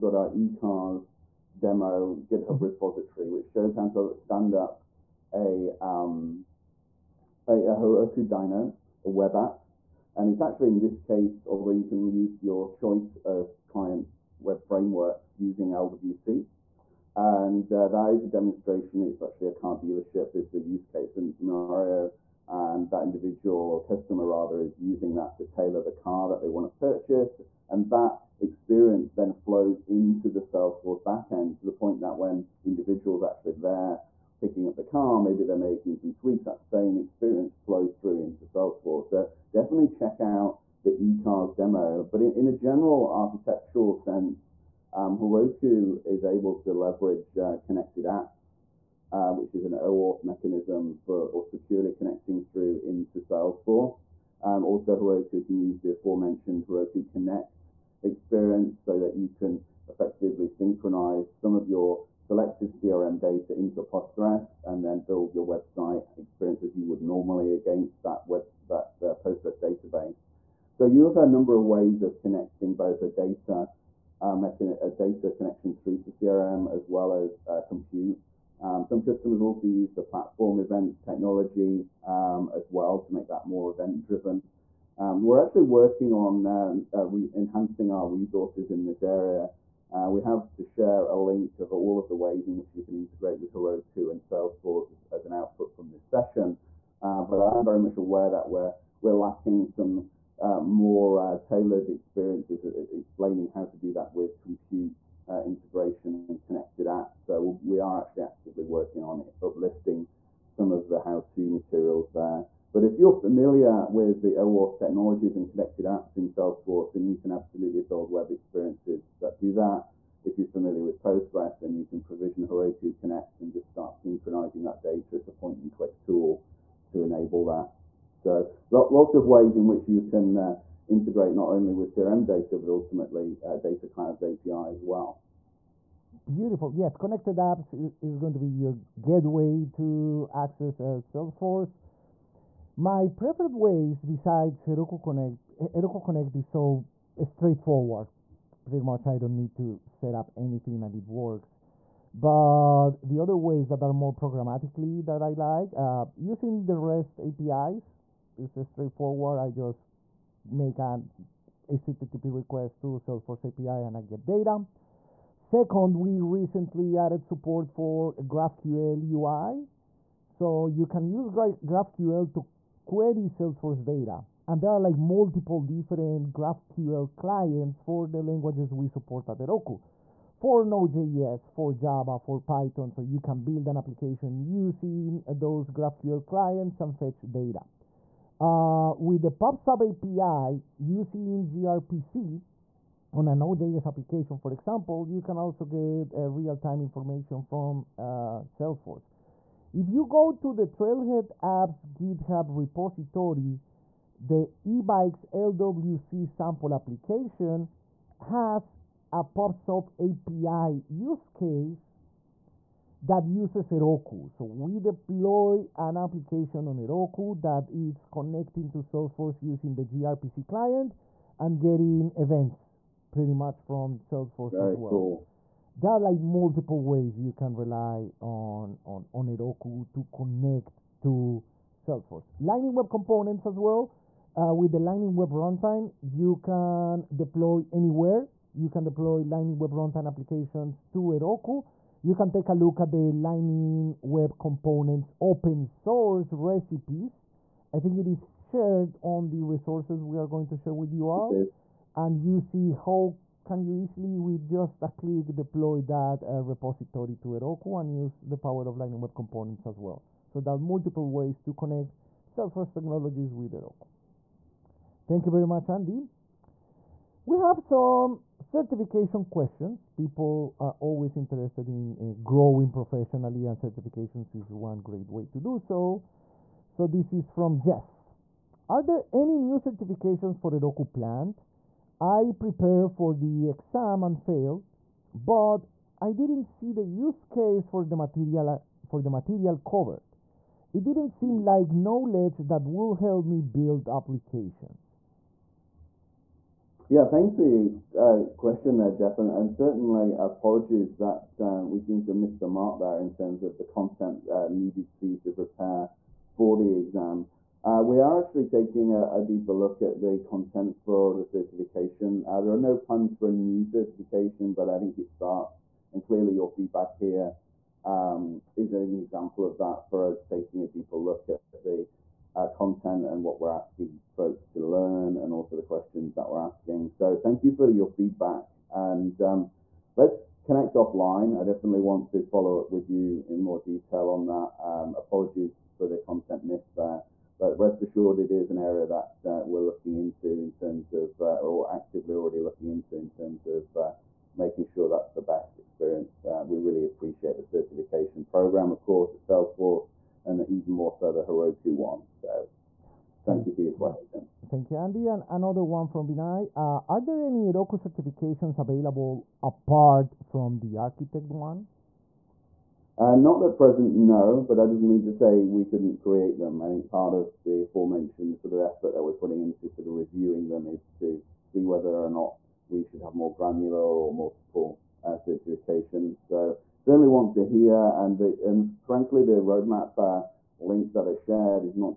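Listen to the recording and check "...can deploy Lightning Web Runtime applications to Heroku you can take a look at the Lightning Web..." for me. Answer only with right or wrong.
right.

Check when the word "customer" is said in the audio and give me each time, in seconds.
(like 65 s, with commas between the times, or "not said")
23 s, 78 s.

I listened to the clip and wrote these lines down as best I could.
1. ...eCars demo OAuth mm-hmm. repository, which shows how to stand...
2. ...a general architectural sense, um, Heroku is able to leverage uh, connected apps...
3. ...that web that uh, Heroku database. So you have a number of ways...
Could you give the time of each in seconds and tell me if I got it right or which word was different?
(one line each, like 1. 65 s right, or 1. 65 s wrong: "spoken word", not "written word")
1. 0 s wrong: "GitHub", not "OAuth"
2. 42 s right
3. 68 s wrong: "Postgres", not "Heroku".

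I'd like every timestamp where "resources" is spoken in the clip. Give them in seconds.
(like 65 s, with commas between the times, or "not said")
88 s, 249 s.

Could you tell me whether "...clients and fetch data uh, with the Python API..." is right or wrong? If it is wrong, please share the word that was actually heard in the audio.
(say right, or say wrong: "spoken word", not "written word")
wrong: "PubSub", not "Python".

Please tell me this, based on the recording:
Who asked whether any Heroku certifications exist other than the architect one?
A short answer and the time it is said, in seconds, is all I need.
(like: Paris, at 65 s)
Binay, at 356 s.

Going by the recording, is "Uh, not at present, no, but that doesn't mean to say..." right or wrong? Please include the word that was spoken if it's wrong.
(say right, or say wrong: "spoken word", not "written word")
right.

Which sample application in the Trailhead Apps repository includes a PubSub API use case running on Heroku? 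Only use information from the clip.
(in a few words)
eBikes LWC.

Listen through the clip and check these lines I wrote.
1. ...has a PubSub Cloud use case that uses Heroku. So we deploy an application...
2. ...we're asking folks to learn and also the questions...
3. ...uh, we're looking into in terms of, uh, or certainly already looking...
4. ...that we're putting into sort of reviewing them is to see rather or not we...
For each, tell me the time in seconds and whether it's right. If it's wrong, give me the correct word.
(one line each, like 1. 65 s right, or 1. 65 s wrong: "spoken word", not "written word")
1. 208 s wrong: "API", not "Cloud"
2. 323 s right
3. 339 s wrong: "actively", not "certainly"
4. 368 s wrong: "whether", not "rather".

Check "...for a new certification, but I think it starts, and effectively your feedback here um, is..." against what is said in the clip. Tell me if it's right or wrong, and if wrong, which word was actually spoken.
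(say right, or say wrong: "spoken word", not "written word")
wrong: "clearly", not "effectively".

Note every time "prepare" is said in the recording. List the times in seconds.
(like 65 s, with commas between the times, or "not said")
282 s, 305 s.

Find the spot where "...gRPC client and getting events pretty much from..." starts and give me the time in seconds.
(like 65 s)
219 s.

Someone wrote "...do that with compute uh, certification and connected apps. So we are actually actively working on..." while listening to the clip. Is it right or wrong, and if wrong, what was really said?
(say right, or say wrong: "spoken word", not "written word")
wrong: "integration", not "certification".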